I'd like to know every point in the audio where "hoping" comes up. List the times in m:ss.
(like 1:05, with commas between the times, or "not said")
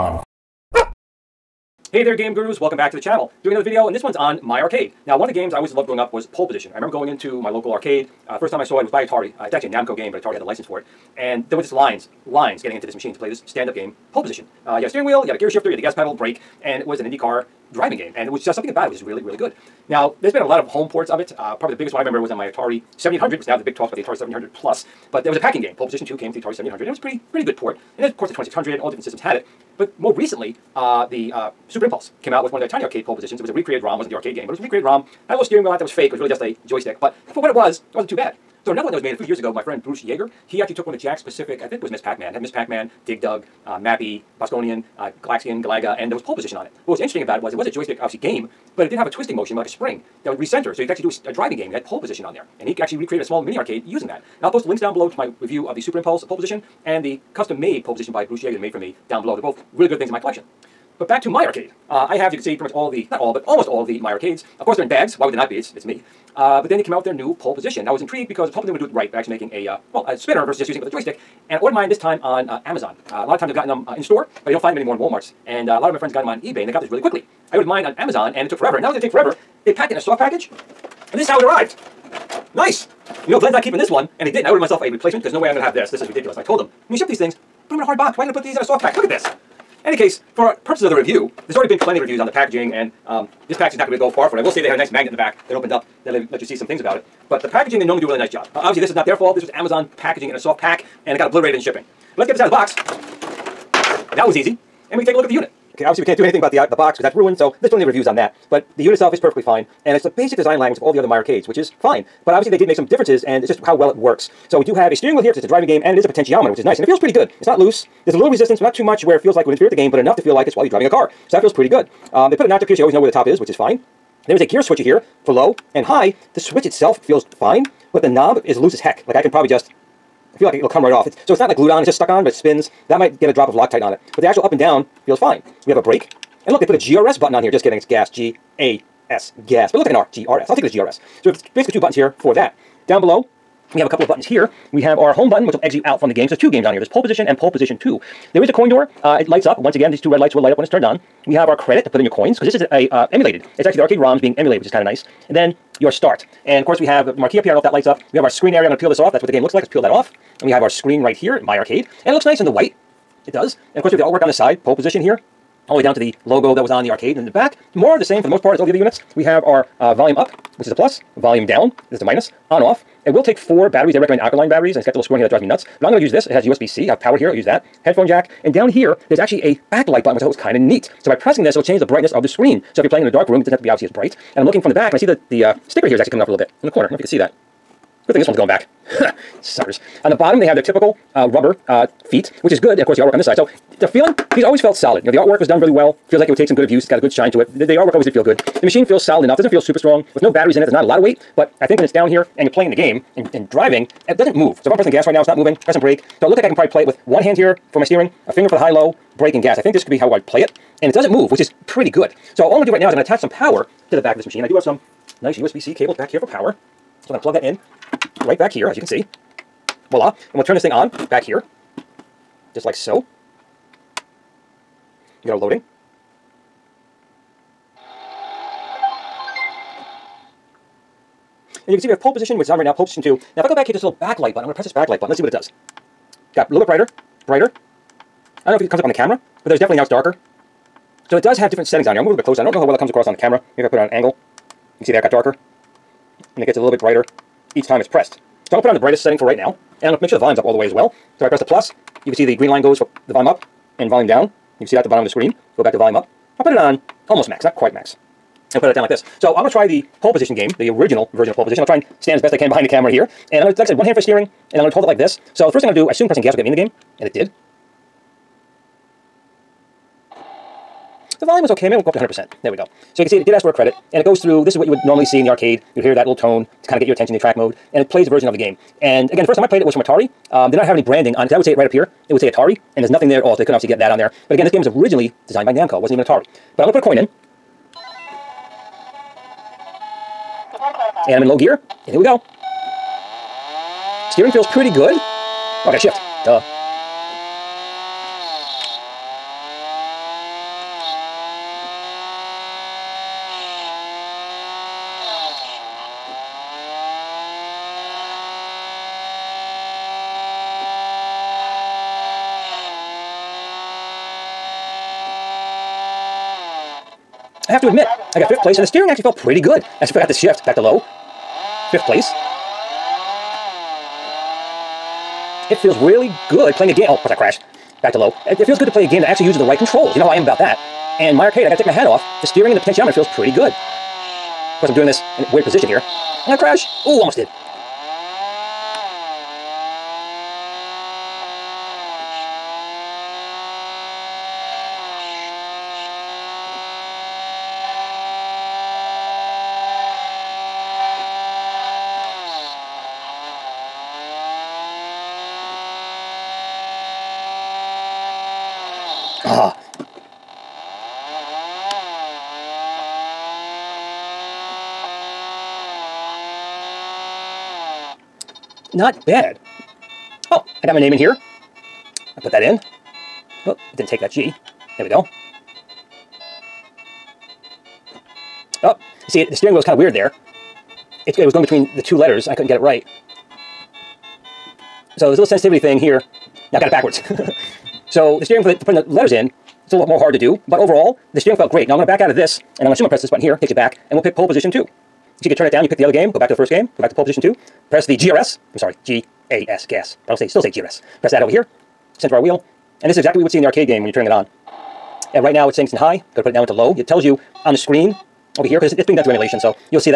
1:08.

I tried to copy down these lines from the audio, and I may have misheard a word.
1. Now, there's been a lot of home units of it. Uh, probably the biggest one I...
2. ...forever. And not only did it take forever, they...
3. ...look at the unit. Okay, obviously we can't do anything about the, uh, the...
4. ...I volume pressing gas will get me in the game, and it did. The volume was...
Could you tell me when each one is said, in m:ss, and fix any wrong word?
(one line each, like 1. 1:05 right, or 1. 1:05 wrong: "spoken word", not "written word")
1. 0:19 wrong: "ports", not "units"
2. 1:18 right
3. 1:45 right
4. 4:25 wrong: "assume", not "volume".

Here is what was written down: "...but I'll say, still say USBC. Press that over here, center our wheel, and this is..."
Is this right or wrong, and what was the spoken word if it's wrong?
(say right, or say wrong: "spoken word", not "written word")
wrong: "GRS", not "USBC".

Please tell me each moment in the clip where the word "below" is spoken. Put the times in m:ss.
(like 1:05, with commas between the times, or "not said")
0:54, 0:59, 2:23.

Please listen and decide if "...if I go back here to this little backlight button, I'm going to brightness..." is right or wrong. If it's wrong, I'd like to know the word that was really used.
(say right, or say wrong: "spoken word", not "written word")
wrong: "press", not "brightness".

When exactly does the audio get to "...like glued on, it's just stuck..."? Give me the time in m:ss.
2:11.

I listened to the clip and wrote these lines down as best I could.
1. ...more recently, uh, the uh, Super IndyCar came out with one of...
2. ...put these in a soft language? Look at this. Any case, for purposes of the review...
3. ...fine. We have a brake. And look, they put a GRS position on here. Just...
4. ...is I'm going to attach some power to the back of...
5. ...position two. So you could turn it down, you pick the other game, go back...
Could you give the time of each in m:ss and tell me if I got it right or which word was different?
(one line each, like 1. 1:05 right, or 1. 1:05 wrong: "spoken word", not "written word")
1. 0:29 wrong: "Impulse", not "IndyCar"
2. 1:28 wrong: "package", not "language"
3. 2:15 wrong: "button", not "position"
4. 3:32 right
5. 6:34 right.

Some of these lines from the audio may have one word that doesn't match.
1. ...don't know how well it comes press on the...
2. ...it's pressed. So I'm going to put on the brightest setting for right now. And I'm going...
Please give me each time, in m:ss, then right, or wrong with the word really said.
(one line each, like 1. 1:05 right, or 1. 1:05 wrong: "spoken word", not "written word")
1. 4:02 wrong: "across", not "press"
2. 4:07 right.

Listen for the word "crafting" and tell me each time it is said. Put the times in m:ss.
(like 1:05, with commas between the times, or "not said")
not said.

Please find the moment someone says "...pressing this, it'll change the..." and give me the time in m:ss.
3:01.